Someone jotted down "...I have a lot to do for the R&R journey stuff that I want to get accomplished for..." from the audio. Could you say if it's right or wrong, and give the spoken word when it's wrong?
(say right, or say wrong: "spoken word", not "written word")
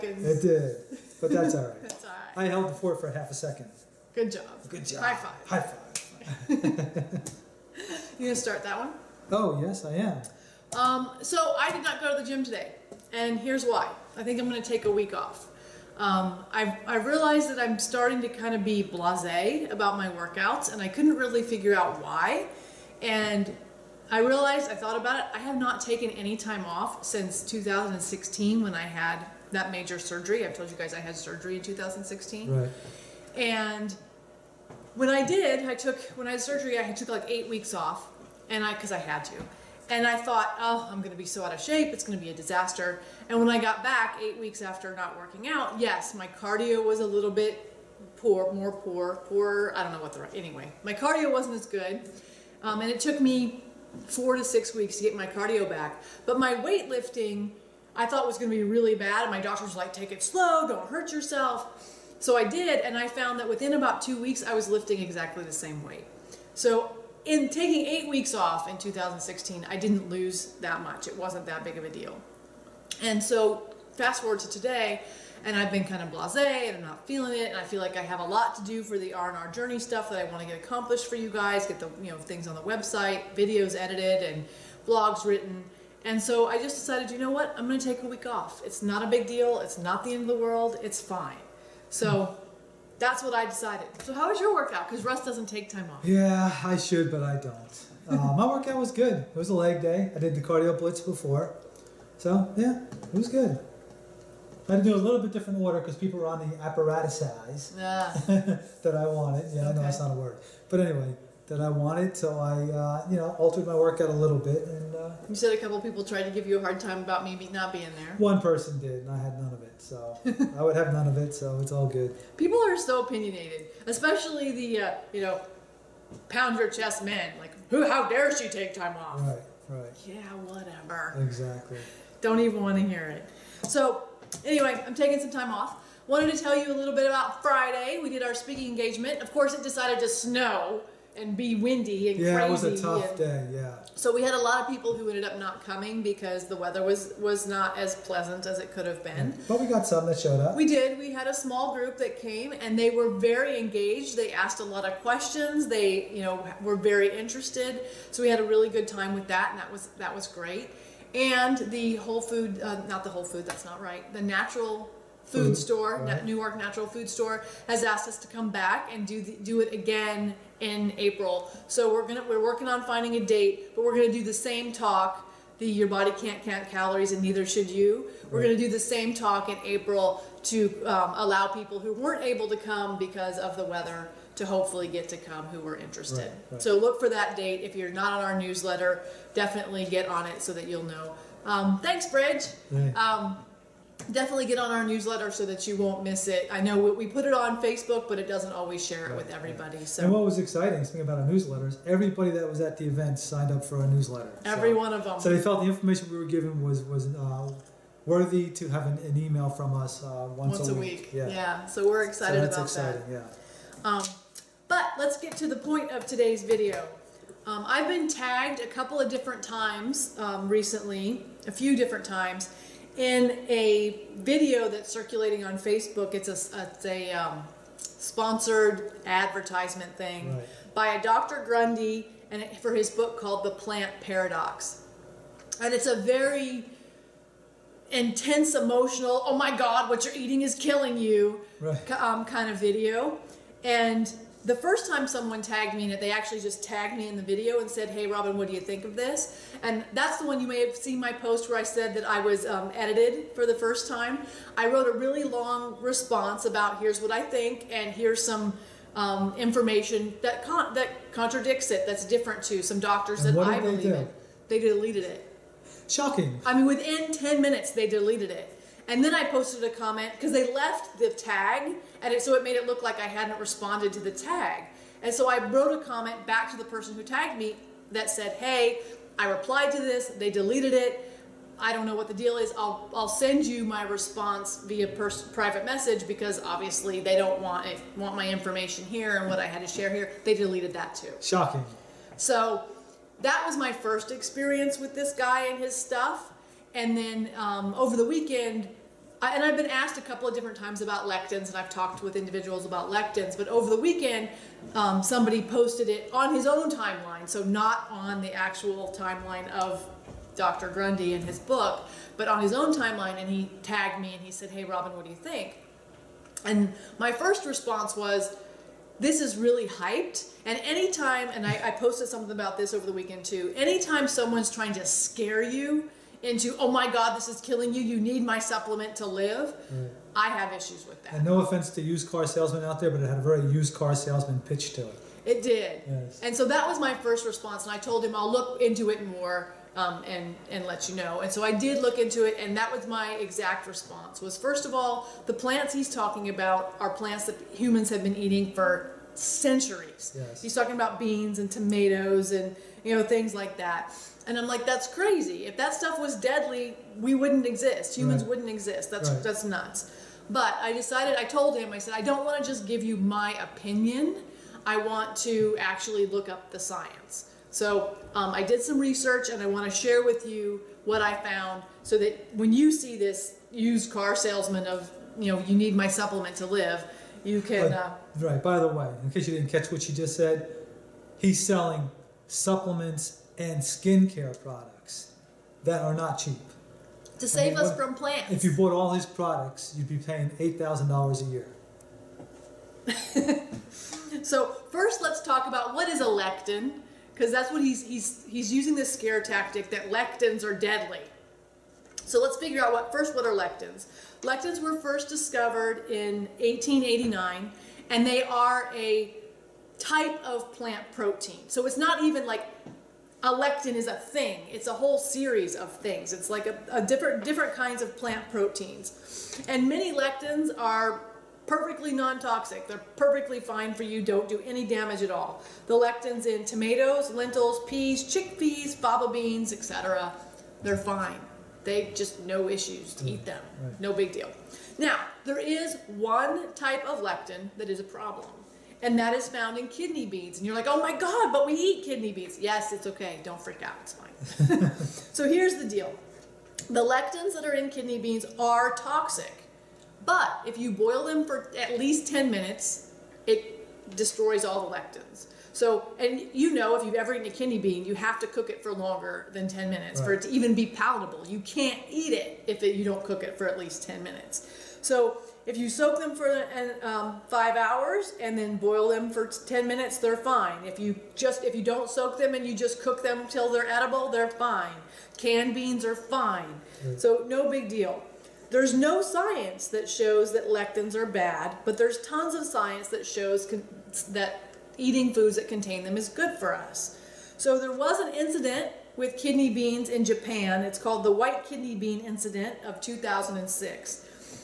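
right.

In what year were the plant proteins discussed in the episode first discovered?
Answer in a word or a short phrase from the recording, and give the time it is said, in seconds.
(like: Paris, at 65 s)
1889, at 406 s.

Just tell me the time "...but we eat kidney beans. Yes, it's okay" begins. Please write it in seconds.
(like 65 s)
441 s.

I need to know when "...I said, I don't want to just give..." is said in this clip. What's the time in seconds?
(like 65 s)
361 s.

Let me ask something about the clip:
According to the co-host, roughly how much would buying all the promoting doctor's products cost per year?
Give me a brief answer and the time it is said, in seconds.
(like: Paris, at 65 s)
$8,000, at 390 s.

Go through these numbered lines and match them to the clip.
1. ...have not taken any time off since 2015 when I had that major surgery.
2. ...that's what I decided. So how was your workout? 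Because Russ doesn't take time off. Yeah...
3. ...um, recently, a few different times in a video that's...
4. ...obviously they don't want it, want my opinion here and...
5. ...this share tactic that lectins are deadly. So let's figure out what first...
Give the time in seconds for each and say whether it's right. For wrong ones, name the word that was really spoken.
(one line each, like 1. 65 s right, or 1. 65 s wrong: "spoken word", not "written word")
1. 25 s wrong: "2016", not "2015"
2. 93 s right
3. 220 s right
4. 286 s wrong: "information", not "opinion"
5. 398 s wrong: "scare", not "share".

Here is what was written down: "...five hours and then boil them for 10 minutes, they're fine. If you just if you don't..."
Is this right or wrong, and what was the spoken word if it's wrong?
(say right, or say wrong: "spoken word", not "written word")
right.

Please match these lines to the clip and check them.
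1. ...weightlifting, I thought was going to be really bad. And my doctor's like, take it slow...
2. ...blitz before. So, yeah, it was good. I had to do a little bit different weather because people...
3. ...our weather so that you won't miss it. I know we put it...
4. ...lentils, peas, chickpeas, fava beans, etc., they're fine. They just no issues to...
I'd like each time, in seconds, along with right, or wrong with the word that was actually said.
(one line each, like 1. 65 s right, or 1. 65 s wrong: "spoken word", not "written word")
1. 56 s right
2. 100 s wrong: "order", not "weather"
3. 194 s wrong: "newsletter", not "weather"
4. 427 s right.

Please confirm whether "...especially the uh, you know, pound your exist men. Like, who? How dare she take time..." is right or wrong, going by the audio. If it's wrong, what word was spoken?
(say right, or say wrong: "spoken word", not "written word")
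wrong: "chest", not "exist".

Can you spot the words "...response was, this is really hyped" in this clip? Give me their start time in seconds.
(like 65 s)
317 s.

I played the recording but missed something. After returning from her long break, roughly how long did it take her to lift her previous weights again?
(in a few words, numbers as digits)
2 weeks.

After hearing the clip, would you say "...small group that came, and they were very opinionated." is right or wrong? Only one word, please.
wrong.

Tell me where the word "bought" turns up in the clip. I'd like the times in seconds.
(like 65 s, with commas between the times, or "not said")
388 s.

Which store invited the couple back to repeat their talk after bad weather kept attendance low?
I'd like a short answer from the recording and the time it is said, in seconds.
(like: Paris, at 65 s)
Newark Natural Food Store, at 166 s.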